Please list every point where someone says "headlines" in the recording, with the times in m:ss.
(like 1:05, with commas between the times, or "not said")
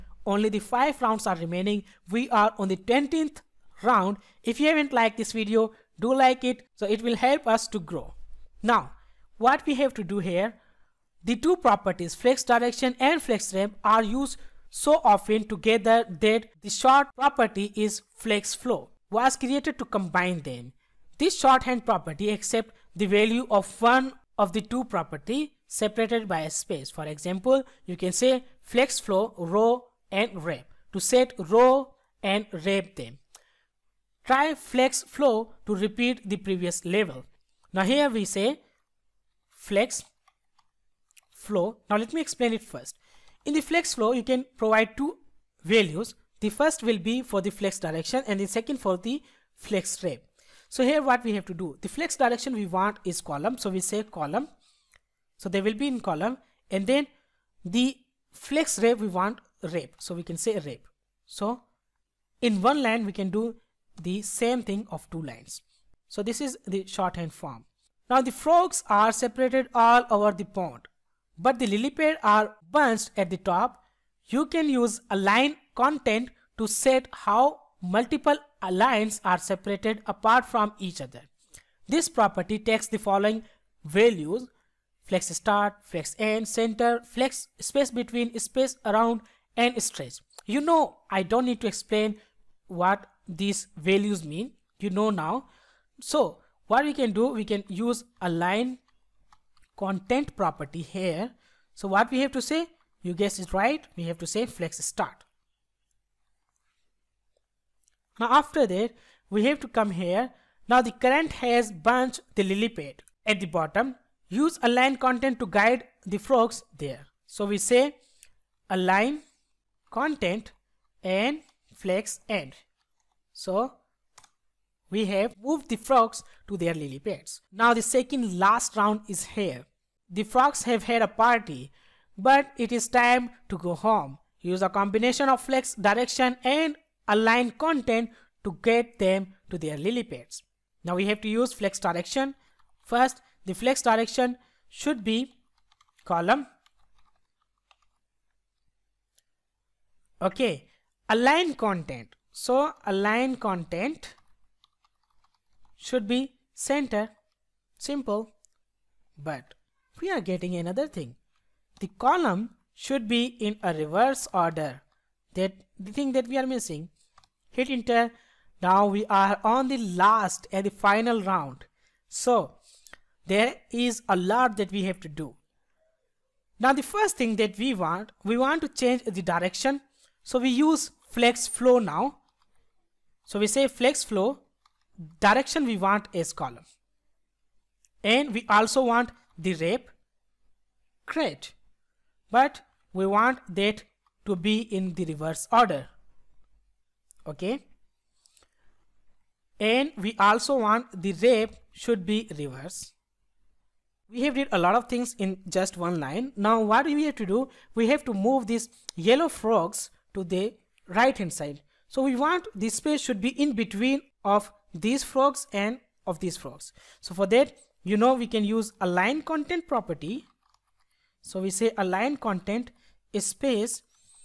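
not said.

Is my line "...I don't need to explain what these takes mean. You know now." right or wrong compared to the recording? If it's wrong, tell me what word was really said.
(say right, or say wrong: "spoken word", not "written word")
wrong: "values", not "takes".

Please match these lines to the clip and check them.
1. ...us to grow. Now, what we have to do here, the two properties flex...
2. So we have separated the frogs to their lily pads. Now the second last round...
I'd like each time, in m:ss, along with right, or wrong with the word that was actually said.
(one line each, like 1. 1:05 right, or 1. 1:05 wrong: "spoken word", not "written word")
1. 0:07 right
2. 2:03 wrong: "moved", not "separated".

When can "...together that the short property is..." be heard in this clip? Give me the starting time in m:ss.
0:15.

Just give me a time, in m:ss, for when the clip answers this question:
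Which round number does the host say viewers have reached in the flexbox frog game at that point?
0:02.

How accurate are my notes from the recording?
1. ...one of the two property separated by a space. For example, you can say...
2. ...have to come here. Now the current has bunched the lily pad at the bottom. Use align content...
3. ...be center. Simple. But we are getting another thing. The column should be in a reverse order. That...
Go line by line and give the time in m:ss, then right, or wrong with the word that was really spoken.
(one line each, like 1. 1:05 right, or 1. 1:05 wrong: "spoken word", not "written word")
1. 0:23 right
2. 1:49 right
3. 2:36 right.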